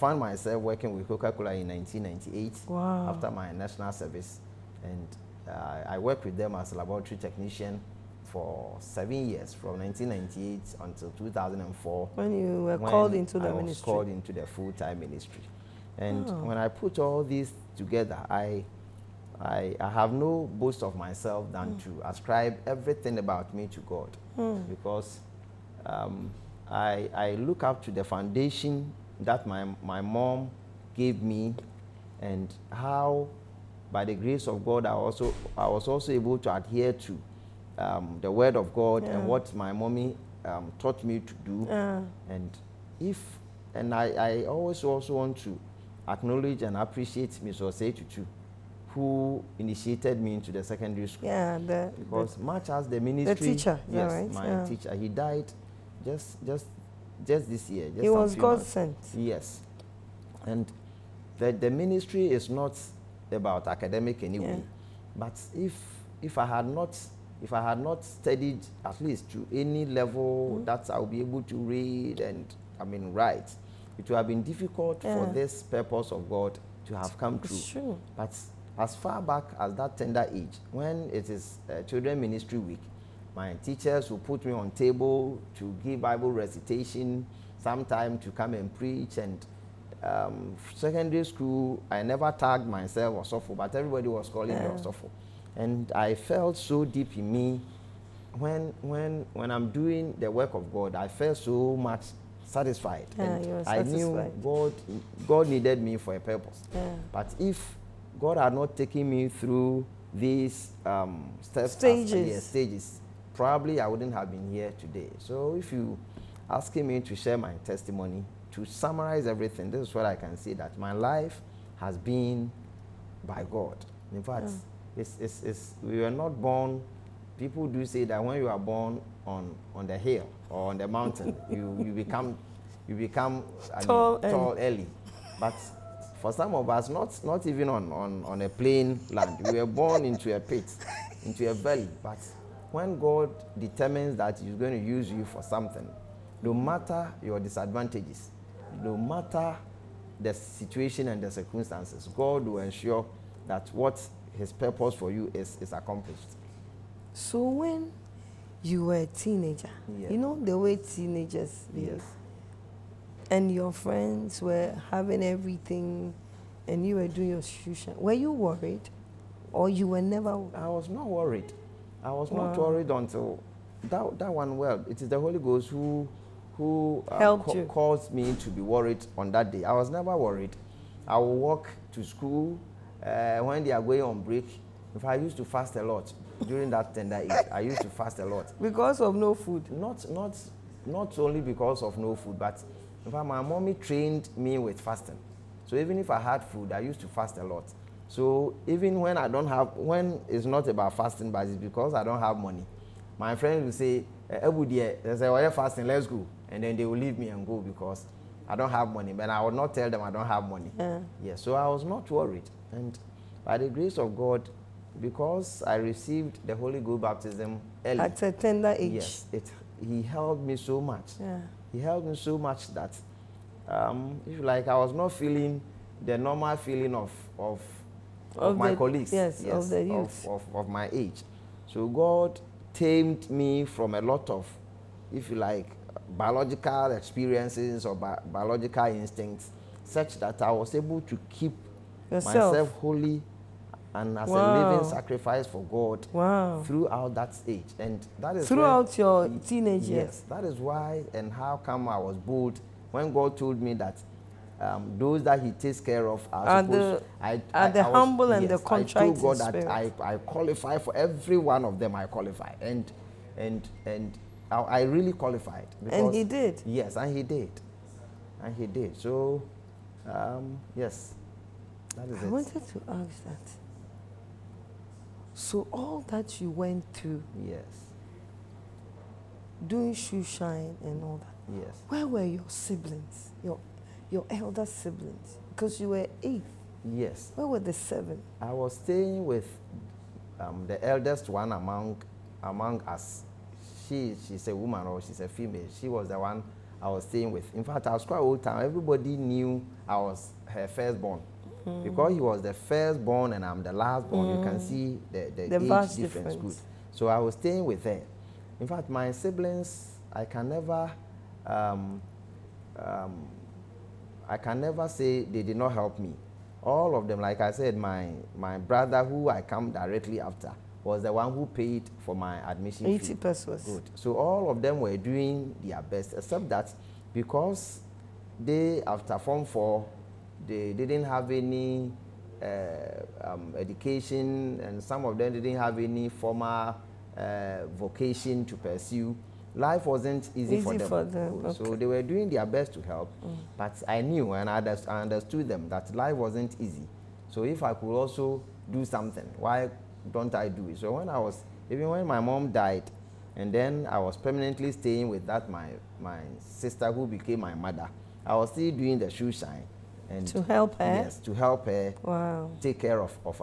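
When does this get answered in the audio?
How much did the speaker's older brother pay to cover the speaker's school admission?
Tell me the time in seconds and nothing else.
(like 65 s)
322 s.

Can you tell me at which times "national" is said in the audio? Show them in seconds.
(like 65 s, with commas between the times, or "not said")
3 s.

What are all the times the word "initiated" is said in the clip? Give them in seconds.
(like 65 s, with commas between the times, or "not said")
49 s.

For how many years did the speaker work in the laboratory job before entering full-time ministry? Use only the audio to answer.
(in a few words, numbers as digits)
7.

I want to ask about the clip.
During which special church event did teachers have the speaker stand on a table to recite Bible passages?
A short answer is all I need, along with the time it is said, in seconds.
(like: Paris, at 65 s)
Children Ministry Week, at 81 s.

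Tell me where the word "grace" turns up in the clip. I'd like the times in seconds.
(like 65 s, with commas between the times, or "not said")
34 s, 213 s.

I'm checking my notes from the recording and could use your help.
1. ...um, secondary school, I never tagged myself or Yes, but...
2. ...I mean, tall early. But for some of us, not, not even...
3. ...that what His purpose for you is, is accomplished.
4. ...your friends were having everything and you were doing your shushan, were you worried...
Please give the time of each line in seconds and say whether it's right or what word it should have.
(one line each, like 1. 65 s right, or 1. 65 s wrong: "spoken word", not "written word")
1. 90 s wrong: "Osofo", not "Yes"
2. 133 s right
3. 153 s right
4. 163 s right.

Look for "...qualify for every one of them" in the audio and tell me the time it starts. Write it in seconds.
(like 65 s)
260 s.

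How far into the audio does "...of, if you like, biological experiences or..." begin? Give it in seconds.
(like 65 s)
234 s.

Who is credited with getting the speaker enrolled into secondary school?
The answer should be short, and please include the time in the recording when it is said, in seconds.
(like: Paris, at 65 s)
Mr. Osei Tutu, at 47 s.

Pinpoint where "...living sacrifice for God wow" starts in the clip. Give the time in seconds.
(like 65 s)
244 s.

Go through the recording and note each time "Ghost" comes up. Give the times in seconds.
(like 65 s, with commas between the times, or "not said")
175 s, 216 s.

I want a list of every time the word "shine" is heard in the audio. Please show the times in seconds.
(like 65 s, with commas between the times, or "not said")
280 s, 359 s.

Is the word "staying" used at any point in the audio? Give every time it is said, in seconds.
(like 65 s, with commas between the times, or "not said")
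288 s, 297 s, 307 s, 354 s.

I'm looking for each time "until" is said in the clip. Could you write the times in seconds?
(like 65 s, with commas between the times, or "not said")
10 s, 172 s.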